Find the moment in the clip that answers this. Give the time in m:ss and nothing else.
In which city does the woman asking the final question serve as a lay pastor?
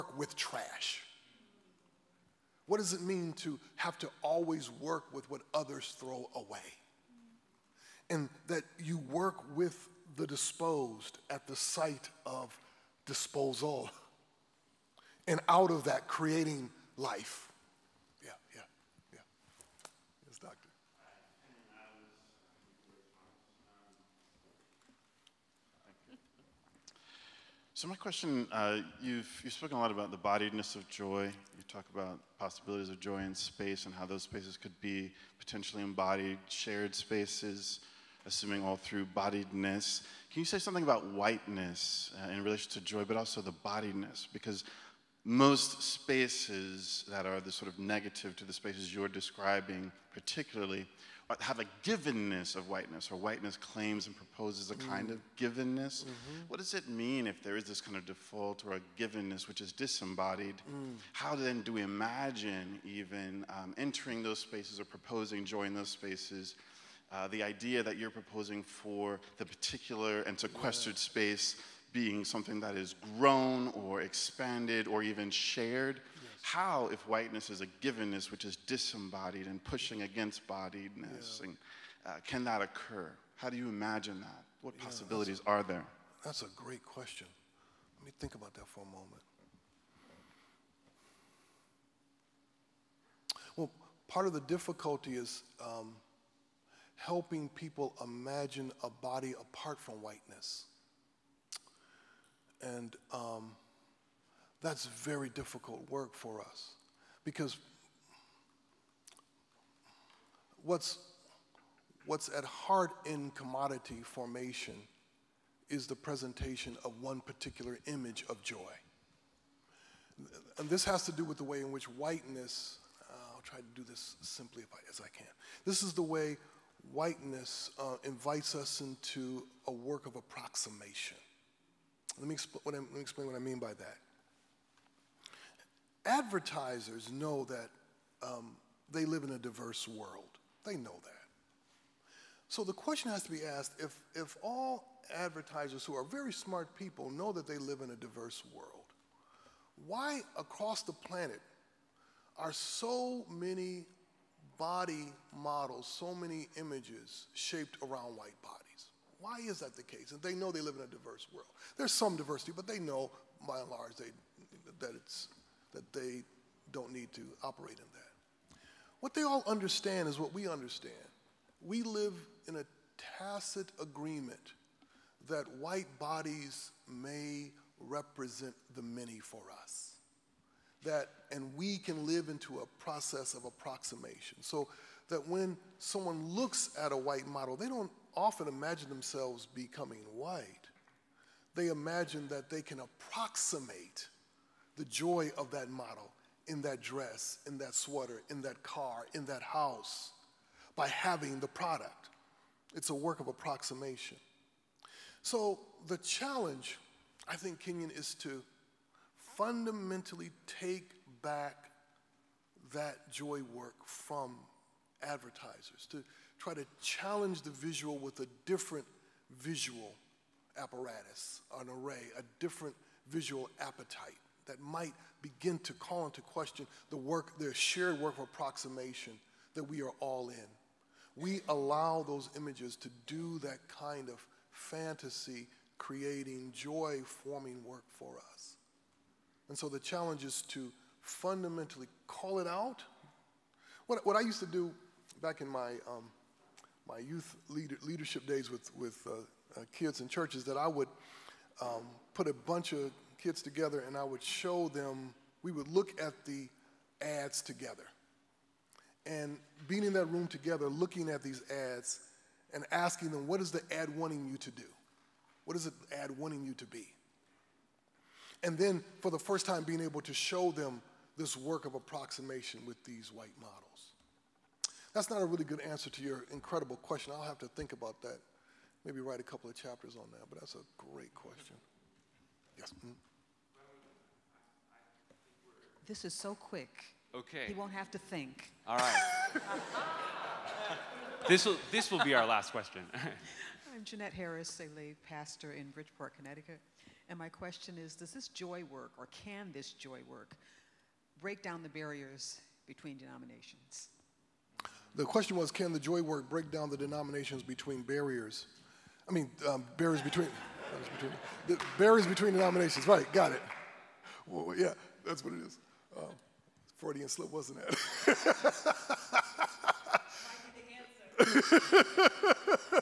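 4:55.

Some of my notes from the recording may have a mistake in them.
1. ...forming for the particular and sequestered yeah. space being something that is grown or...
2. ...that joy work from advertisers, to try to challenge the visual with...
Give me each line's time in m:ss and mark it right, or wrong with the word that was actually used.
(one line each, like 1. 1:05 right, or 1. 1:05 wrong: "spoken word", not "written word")
1. 1:08 wrong: "proposing", not "forming"
2. 3:32 right.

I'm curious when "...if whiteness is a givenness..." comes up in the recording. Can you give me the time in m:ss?
1:16.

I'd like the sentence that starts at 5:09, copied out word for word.
I mean, um, barriers between, between the barriers between denominations.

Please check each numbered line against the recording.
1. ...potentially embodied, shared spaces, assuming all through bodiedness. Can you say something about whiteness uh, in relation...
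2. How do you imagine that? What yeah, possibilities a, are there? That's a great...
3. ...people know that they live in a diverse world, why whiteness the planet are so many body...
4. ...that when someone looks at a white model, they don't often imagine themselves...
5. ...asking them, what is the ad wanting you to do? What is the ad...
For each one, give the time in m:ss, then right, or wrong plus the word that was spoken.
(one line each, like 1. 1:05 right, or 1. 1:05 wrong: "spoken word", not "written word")
1. 0:35 right
2. 1:23 right
3. 2:26 wrong: "across", not "whiteness"
4. 3:05 right
5. 4:22 right.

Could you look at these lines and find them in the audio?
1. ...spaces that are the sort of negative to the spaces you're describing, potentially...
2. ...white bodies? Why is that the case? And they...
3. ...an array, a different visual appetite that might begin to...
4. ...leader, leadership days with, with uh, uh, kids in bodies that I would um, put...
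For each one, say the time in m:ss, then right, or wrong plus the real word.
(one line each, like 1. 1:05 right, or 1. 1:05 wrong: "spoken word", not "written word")
1. 0:45 wrong: "particularly", not "potentially"
2. 2:38 right
3. 3:41 right
4. 4:07 wrong: "churches", not "bodies".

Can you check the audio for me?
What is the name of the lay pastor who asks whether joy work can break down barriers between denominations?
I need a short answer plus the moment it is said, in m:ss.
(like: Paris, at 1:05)
Jeanette Harris, at 4:53.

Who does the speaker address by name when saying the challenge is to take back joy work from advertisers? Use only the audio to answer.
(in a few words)
Kenyon.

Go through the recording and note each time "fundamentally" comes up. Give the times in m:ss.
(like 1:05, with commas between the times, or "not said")
3:29, 4:01.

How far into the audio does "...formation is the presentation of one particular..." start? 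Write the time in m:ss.
1:54.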